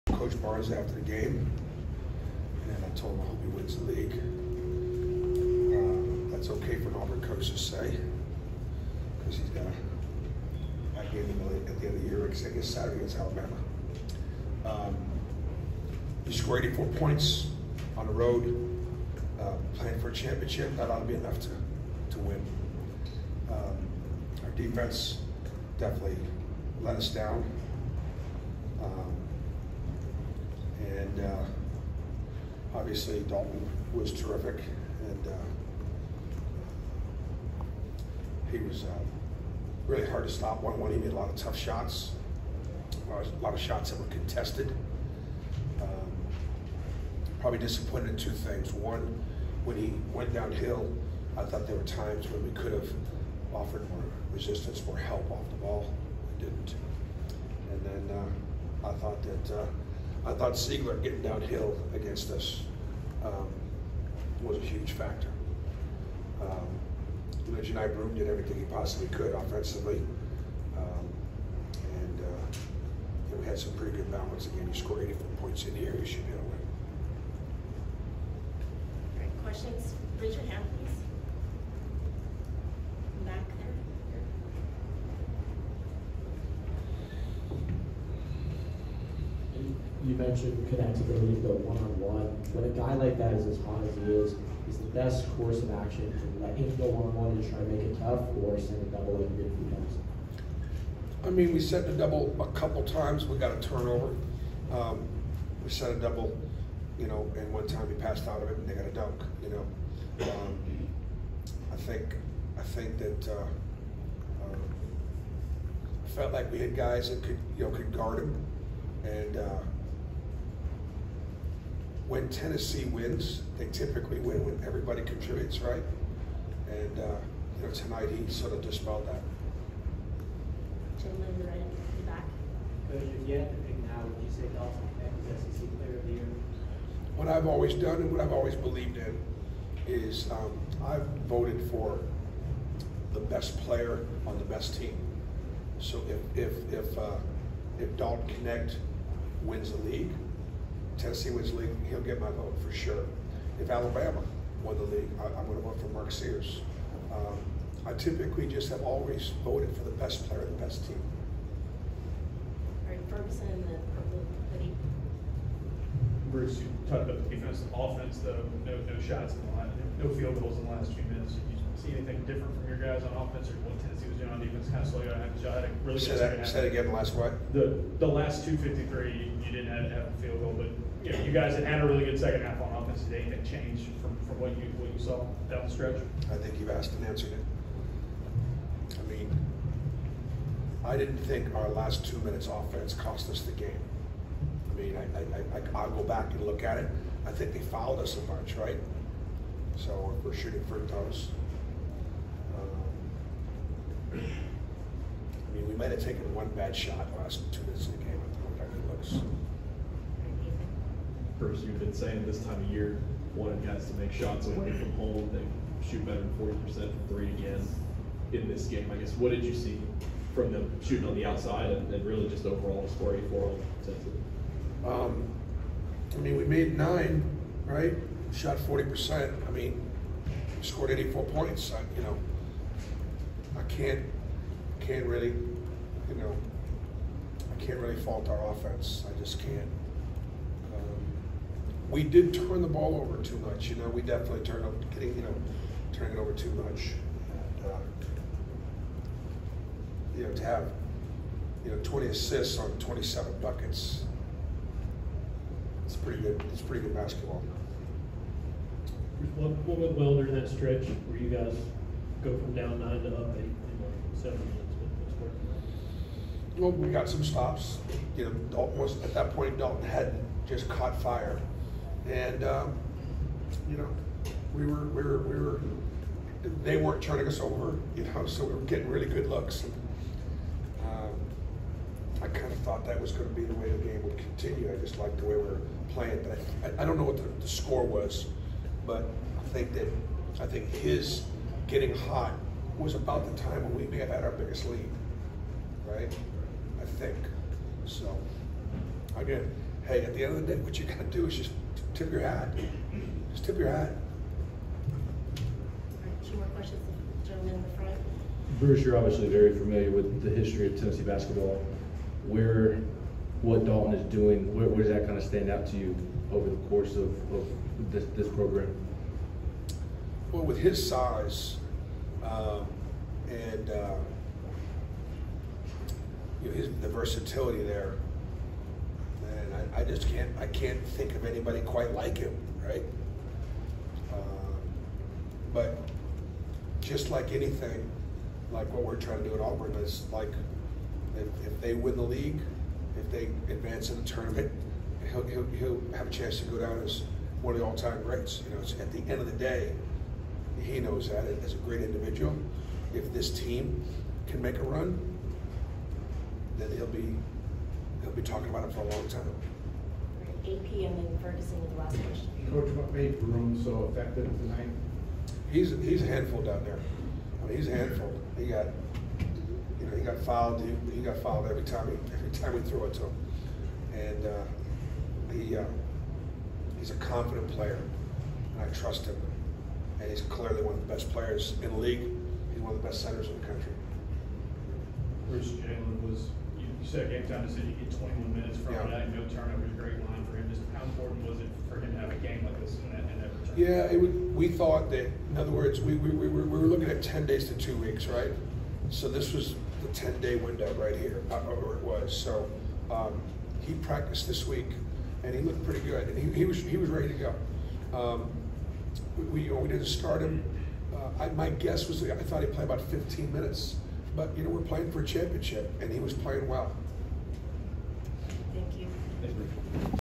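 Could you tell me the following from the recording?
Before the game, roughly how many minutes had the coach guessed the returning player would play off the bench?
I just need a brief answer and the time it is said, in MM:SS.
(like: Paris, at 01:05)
15, at 06:52.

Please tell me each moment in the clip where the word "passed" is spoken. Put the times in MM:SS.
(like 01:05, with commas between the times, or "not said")
01:47.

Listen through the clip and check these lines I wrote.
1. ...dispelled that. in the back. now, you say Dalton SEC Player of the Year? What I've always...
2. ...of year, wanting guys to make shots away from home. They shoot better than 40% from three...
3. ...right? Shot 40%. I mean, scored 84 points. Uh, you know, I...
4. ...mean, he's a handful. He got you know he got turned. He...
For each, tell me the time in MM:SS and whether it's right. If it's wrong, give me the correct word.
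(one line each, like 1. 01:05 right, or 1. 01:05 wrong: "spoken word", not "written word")
1. 02:08 right
2. 03:32 right
3. 03:47 right
4. 06:07 wrong: "fouled", not "turned".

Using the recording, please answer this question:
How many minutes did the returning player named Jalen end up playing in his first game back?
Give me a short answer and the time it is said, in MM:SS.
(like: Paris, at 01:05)
21, at 06:27.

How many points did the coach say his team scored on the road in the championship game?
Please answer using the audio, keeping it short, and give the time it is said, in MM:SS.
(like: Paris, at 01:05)
84, at 00:16.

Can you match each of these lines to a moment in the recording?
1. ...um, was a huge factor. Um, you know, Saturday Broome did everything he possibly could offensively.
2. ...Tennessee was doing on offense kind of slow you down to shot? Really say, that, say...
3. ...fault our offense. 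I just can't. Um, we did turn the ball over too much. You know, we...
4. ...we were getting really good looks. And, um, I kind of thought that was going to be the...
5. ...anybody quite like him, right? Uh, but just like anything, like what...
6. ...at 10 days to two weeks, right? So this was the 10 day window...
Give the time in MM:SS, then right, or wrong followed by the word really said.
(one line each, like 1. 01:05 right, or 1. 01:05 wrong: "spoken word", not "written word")
1. 01:03 wrong: "Johni", not "Saturday"
2. 02:53 wrong: "defense", not "offense"
3. 03:57 right
4. 04:38 right
5. 05:31 right
6. 06:36 right.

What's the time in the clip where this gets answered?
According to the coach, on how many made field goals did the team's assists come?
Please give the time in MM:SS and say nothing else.
04:12.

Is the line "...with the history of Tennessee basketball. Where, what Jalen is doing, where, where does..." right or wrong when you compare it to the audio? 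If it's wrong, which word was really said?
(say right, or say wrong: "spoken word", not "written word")
wrong: "Dalton", not "Jalen".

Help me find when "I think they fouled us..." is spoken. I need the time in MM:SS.
03:17.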